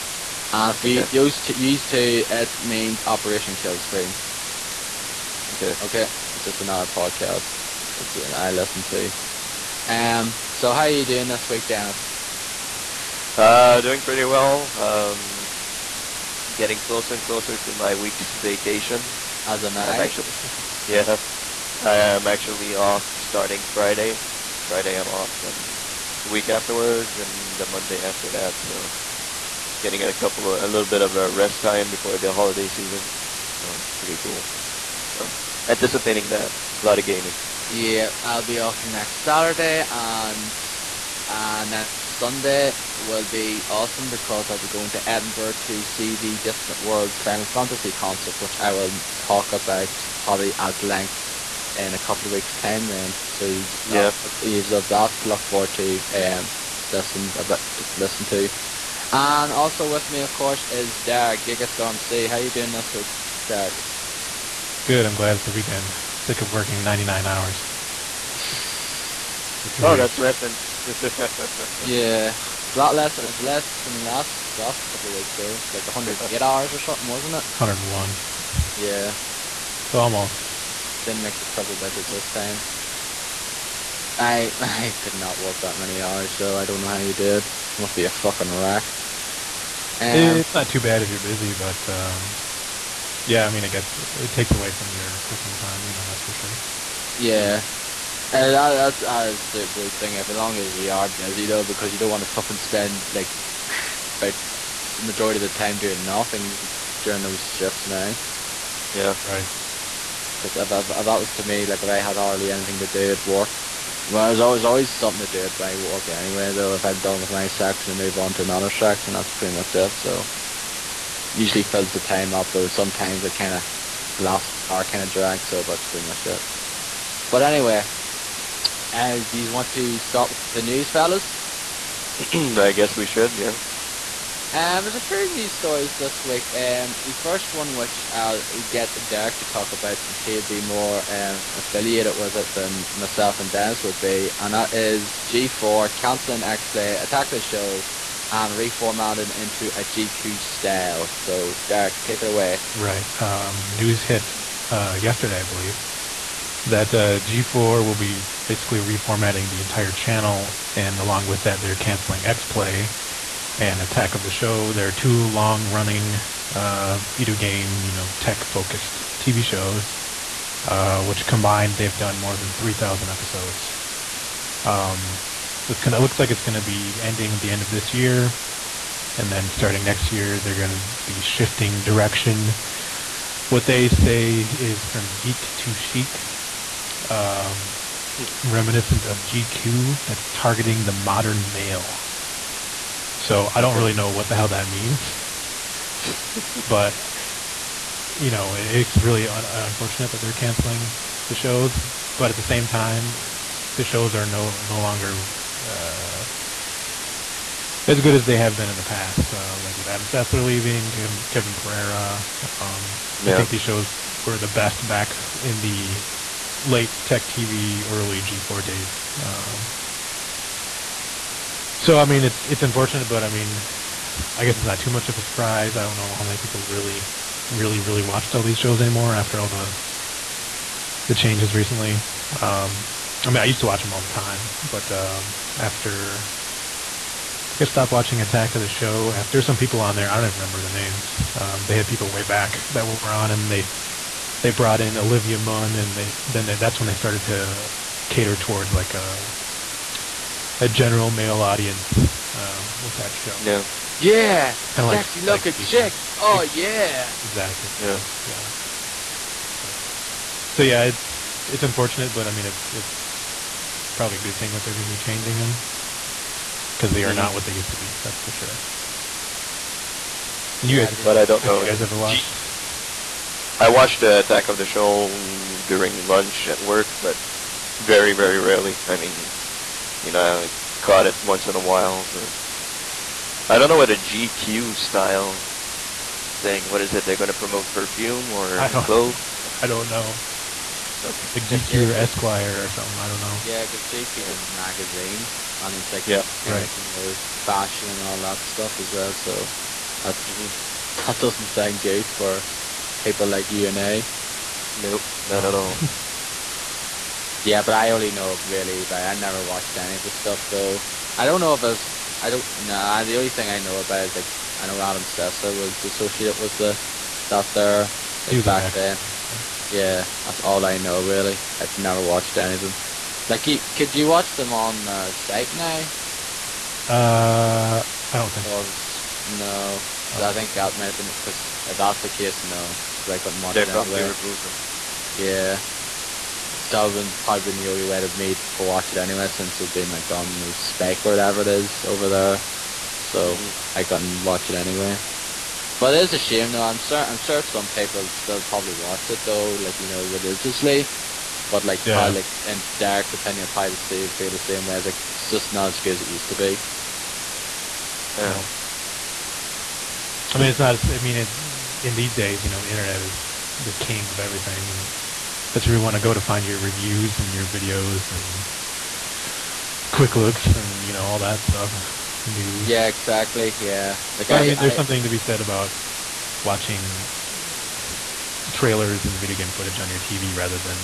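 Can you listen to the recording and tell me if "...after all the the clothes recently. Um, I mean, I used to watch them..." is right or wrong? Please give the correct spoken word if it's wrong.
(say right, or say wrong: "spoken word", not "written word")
wrong: "changes", not "clothes".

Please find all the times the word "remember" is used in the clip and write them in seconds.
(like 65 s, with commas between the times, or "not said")
240 s.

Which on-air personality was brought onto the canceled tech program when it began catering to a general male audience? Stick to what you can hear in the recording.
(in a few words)
Olivia Munn.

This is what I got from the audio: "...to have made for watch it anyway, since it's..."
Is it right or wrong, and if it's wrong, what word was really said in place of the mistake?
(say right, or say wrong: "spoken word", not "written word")
right.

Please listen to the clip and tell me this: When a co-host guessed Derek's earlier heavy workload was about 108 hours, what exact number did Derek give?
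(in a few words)
101.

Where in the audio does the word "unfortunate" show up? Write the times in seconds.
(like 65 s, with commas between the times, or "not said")
199 s, 222 s, 261 s.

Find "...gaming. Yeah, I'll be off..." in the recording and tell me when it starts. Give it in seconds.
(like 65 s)
37 s.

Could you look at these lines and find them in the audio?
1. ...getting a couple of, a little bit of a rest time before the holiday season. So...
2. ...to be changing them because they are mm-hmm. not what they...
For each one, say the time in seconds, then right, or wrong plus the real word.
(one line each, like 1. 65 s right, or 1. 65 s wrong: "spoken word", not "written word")
1. 29 s right
2. 264 s right.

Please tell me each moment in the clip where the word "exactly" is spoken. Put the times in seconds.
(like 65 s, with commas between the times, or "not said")
257 s, 372 s.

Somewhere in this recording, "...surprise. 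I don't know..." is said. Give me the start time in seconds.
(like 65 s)
225 s.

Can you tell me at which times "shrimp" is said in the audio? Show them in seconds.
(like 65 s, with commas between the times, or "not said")
not said.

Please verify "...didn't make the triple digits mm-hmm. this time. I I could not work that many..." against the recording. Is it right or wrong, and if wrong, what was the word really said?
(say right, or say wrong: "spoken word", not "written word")
right.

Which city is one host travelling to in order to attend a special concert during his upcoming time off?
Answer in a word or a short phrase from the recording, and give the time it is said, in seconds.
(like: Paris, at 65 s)
Edinburgh, at 45 s.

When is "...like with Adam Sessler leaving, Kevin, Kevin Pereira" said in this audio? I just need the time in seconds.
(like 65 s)
209 s.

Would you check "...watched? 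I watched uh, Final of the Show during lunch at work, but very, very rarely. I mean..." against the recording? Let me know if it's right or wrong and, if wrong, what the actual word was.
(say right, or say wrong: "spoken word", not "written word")
wrong: "Attack", not "Final".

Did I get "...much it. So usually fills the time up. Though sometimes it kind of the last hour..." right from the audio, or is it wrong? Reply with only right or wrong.
right.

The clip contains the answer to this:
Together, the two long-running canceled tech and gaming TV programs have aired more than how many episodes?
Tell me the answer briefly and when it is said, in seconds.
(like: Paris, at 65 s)
3,000, at 172 s.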